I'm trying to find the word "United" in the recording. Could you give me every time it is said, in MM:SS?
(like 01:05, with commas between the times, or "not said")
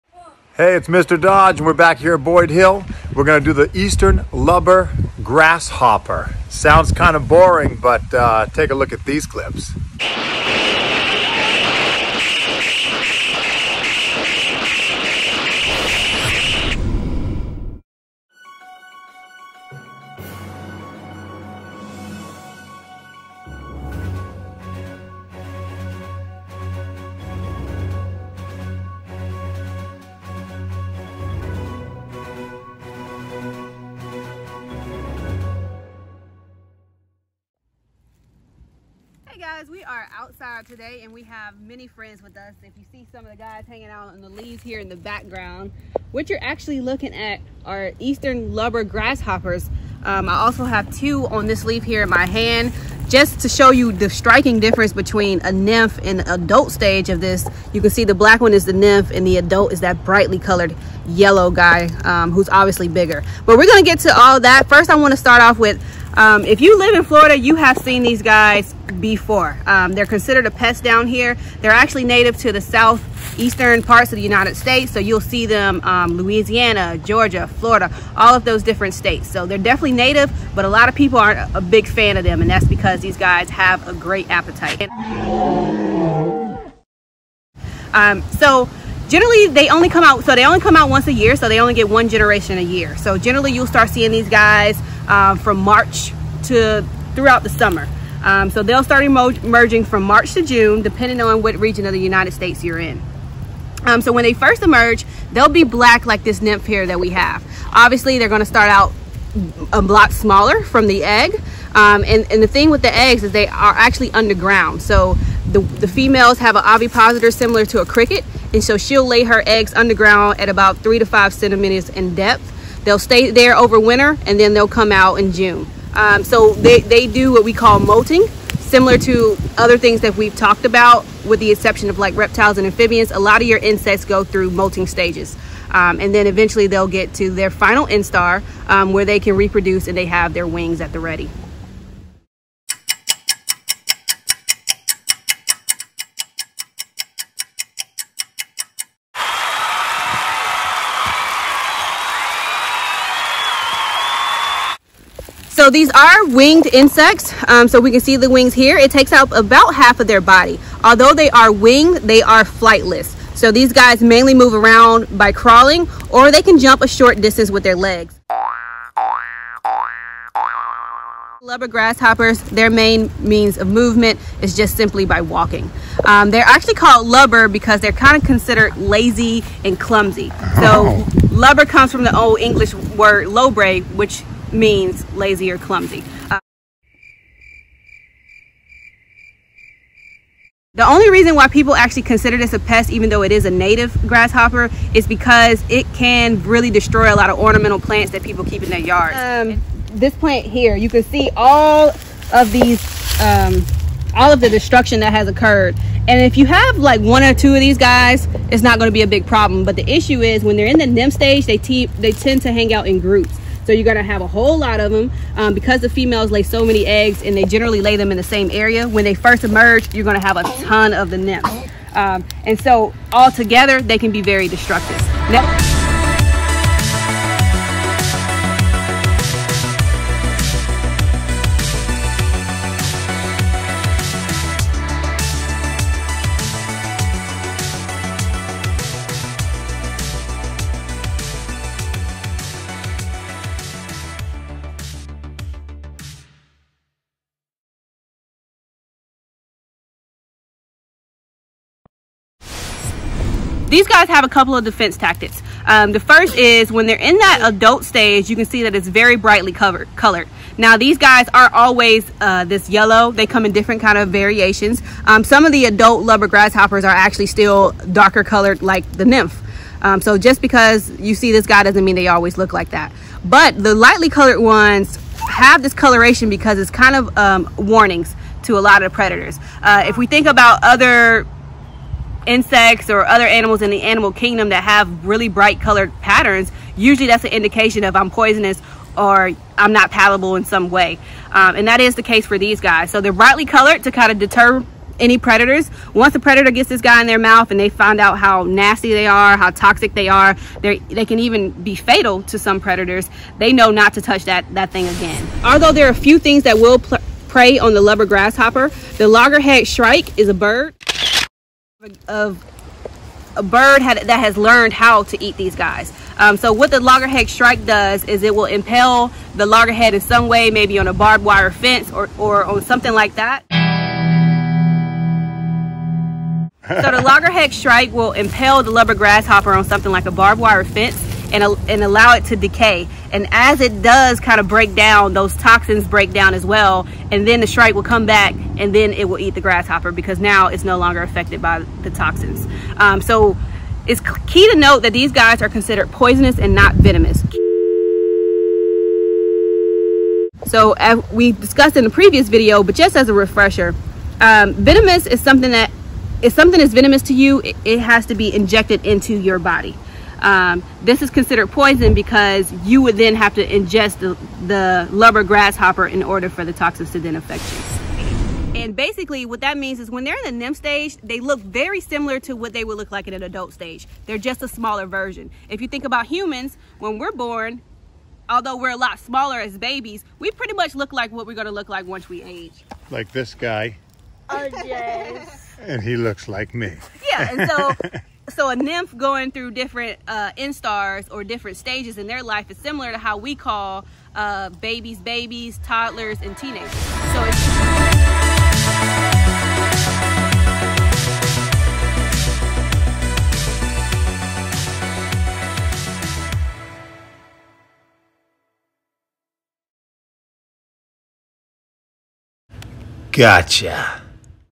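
01:14, 01:41.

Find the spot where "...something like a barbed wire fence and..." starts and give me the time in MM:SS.
05:29.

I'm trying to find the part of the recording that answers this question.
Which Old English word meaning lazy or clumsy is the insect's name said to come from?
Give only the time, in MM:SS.
03:03.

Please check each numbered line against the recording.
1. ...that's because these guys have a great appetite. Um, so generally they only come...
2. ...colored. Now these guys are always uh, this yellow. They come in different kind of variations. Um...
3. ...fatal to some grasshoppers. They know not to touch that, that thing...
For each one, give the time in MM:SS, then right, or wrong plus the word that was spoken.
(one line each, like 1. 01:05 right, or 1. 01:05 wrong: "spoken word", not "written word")
1. 01:22 right
2. 04:19 right
3. 05:01 wrong: "predators", not "grasshoppers".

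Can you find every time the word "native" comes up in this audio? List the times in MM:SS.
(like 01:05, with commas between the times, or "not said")
01:12, 01:19, 03:13.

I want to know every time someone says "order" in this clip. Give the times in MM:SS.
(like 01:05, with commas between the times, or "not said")
06:06.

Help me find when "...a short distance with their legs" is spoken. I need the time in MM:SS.
02:46.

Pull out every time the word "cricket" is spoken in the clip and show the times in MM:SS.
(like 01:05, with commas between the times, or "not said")
01:57.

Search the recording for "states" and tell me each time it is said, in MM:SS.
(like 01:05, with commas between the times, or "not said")
01:14, 01:18, 01:42.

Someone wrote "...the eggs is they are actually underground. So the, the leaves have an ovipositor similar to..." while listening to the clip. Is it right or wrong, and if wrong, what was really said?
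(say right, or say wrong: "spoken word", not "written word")
wrong: "females", not "leaves".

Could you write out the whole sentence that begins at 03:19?
Um, this plant here, you can see all of these, um, all of the destruction that has occurred.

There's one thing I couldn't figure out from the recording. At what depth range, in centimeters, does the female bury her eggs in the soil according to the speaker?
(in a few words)
3 to 5 centimeters.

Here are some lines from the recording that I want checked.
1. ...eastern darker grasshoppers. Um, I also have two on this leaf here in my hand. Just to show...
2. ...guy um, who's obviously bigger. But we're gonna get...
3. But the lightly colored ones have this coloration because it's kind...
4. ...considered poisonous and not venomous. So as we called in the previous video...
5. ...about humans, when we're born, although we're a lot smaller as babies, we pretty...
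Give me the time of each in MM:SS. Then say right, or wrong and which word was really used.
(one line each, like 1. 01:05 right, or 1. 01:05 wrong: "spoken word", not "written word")
1. 00:47 wrong: "lubber", not "darker"
2. 01:01 right
3. 04:33 right
4. 05:45 wrong: "discussed", not "called"
5. 06:15 right.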